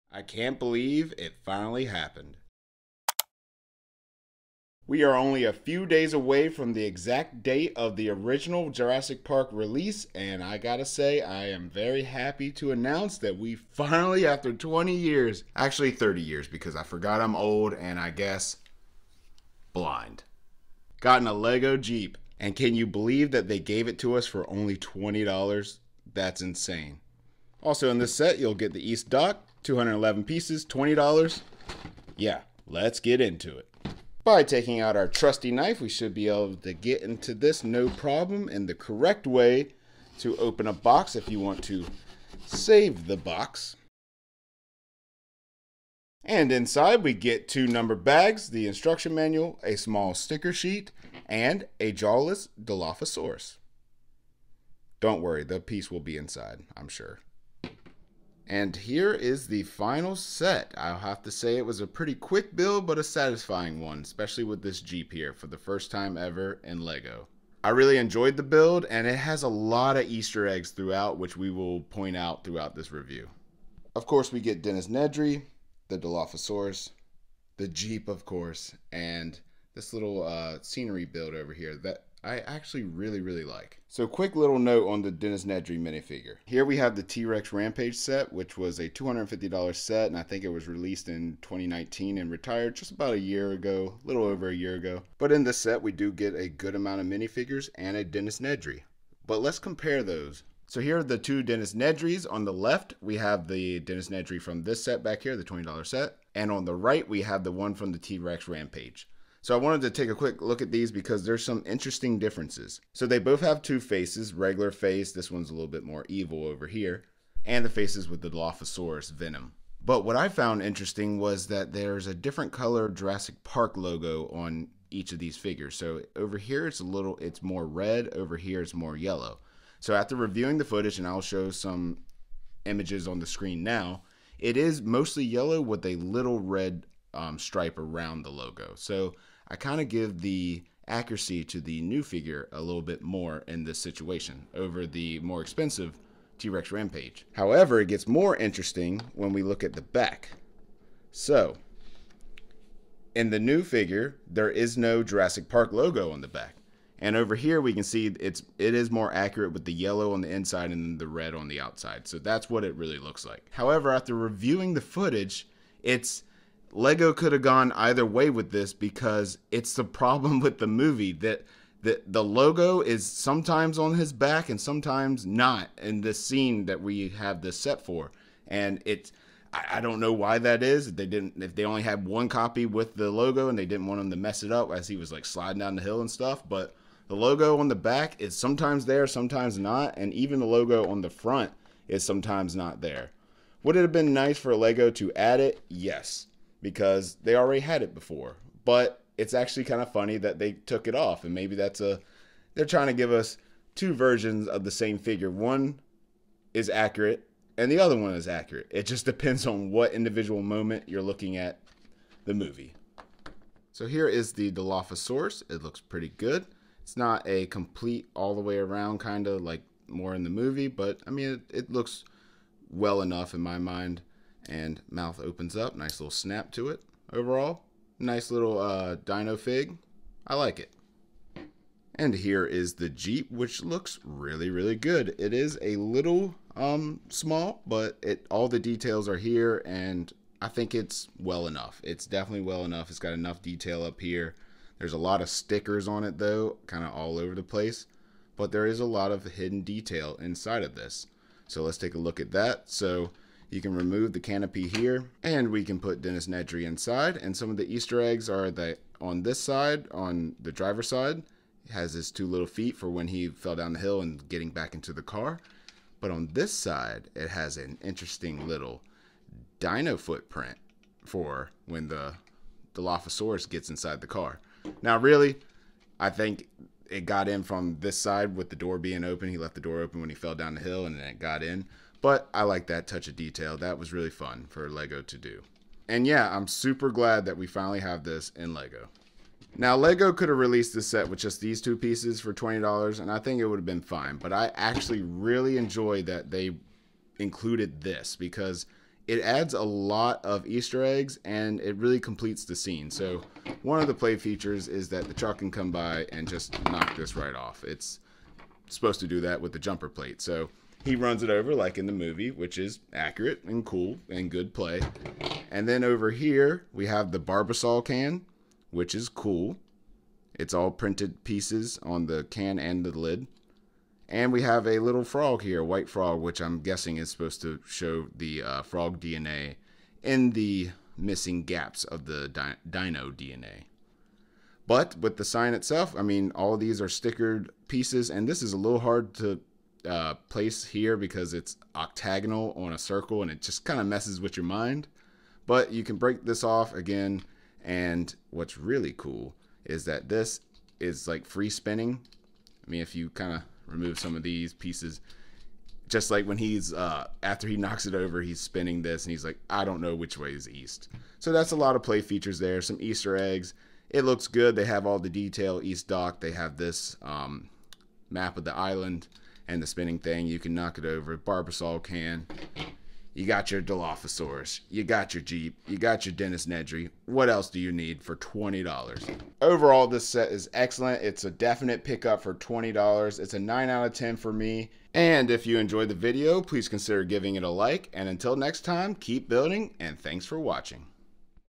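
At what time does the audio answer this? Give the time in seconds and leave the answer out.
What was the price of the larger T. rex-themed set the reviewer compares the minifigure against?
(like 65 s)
88 s.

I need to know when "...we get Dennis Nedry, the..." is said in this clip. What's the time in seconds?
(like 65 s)
74 s.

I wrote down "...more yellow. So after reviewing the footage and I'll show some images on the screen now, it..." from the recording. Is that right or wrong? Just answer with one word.
right.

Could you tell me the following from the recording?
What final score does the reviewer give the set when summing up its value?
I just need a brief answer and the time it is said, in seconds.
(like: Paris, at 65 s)
9 out of 10, at 383 s.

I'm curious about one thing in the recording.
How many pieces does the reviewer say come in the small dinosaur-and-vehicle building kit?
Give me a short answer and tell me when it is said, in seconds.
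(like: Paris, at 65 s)
211, at 29 s.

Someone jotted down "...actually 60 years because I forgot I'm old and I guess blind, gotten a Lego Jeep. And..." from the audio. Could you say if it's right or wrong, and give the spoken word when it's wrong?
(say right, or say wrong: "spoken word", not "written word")
wrong: "30", not "60".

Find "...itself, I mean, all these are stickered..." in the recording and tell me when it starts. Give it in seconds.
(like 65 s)
335 s.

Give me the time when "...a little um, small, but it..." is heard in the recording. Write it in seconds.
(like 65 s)
235 s.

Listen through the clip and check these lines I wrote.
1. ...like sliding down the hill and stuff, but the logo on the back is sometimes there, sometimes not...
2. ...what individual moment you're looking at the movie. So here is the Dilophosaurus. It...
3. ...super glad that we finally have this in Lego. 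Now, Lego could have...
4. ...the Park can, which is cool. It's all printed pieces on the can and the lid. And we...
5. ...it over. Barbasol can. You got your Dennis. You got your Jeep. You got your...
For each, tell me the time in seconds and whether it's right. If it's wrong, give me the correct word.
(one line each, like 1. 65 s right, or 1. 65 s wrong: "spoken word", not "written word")
1. 185 s right
2. 209 s right
3. 286 s right
4. 317 s wrong: "Barbasol", not "Park"
5. 370 s wrong: "Dilophosaurus", not "Dennis".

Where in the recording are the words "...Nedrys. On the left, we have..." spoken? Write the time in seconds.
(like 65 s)
101 s.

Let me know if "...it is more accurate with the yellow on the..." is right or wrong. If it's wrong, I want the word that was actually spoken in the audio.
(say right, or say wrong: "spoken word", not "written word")
right.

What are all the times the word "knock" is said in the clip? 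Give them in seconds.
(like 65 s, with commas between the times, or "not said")
306 s, 357 s, 370 s.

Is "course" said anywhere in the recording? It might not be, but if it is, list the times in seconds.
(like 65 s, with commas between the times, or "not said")
74 s, 78 s.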